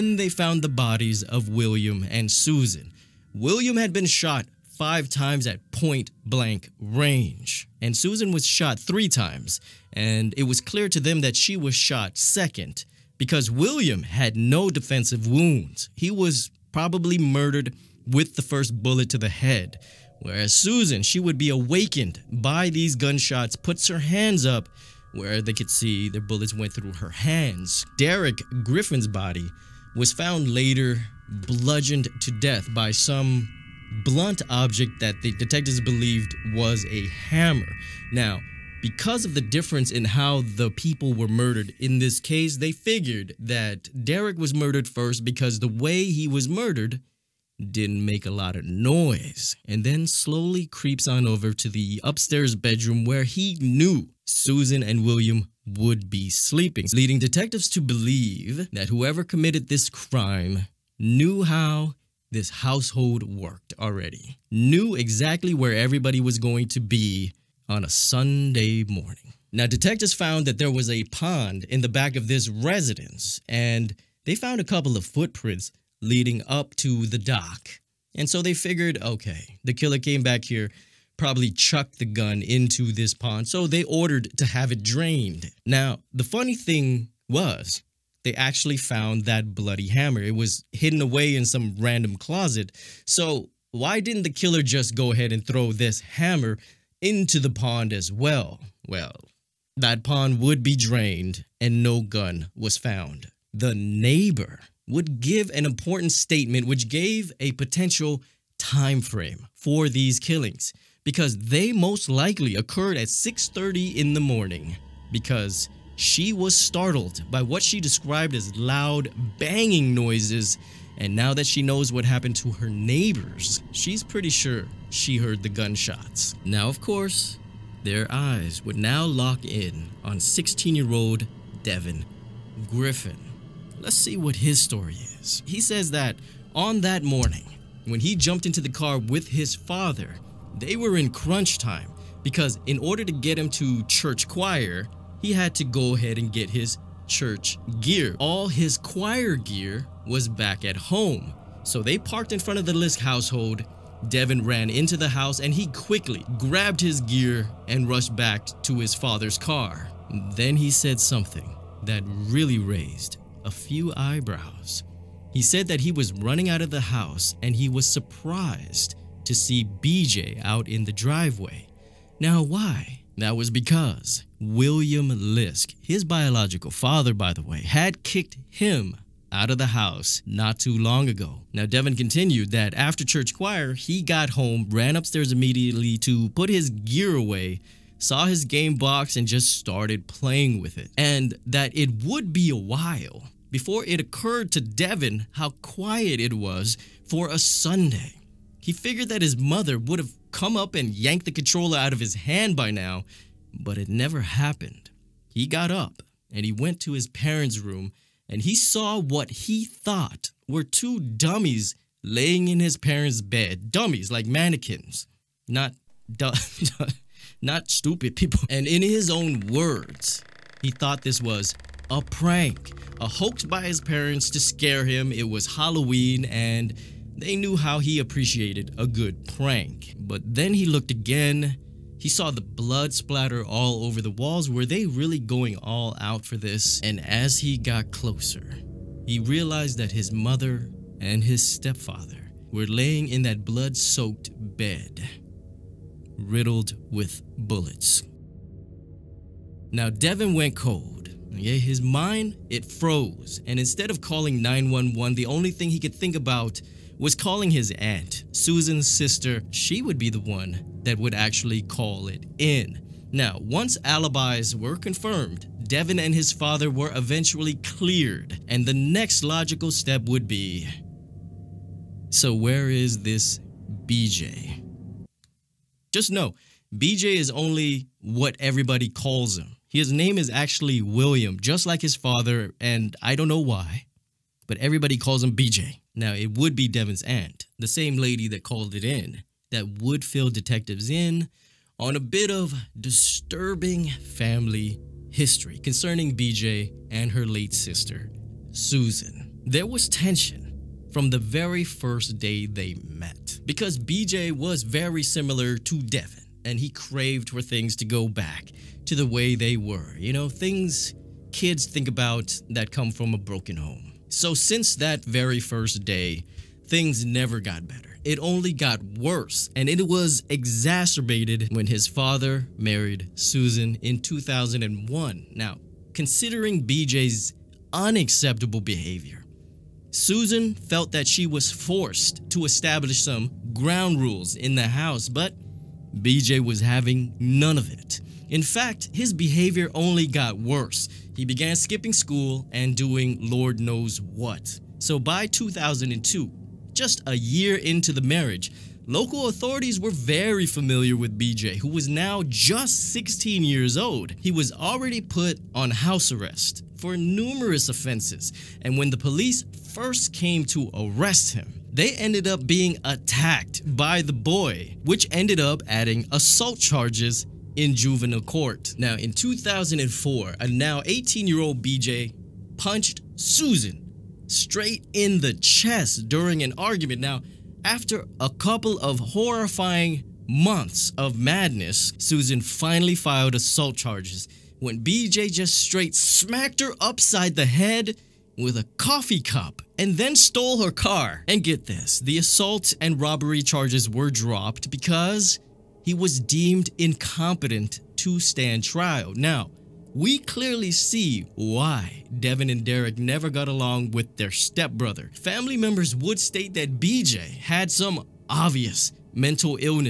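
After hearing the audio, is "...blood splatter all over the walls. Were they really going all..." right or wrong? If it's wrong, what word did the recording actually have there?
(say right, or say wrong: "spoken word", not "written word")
right.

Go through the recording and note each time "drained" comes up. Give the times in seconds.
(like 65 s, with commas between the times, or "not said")
84 s, 100 s.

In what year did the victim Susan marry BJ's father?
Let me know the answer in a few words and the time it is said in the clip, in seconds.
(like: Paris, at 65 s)
2001, at 324 s.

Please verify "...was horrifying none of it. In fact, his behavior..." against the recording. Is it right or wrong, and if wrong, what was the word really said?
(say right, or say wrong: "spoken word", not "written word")
wrong: "having", not "horrifying".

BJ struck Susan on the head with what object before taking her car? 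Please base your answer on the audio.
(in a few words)
A coffee cup.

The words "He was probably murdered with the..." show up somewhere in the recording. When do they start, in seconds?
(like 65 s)
15 s.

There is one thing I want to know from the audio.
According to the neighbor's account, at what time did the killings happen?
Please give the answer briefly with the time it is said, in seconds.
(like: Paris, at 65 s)
6:30 in the morning, at 113 s.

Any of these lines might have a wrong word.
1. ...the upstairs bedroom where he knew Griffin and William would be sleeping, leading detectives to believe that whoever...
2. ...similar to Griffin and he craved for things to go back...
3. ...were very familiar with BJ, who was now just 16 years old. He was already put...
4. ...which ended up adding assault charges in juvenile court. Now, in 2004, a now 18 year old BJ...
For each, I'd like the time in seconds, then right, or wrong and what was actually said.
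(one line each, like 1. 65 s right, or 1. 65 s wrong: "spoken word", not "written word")
1. 51 s wrong: "Susan", not "Griffin"
2. 305 s wrong: "Devin", not "Griffin"
3. 349 s right
4. 364 s right.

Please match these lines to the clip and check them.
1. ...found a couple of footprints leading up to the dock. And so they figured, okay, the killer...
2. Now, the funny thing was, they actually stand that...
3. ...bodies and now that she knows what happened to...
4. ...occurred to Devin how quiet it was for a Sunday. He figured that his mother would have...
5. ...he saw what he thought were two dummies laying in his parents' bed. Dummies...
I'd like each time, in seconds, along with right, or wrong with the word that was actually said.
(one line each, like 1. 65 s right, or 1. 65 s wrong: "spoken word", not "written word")
1. 74 s right
2. 85 s wrong: "found", not "stand"
3. 119 s wrong: "noises", not "bodies"
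4. 194 s right
5. 208 s right.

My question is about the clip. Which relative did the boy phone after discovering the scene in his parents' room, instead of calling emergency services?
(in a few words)
His aunt.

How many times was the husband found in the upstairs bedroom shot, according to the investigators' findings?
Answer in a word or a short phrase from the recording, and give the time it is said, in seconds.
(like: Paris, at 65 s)
5, at 4 s.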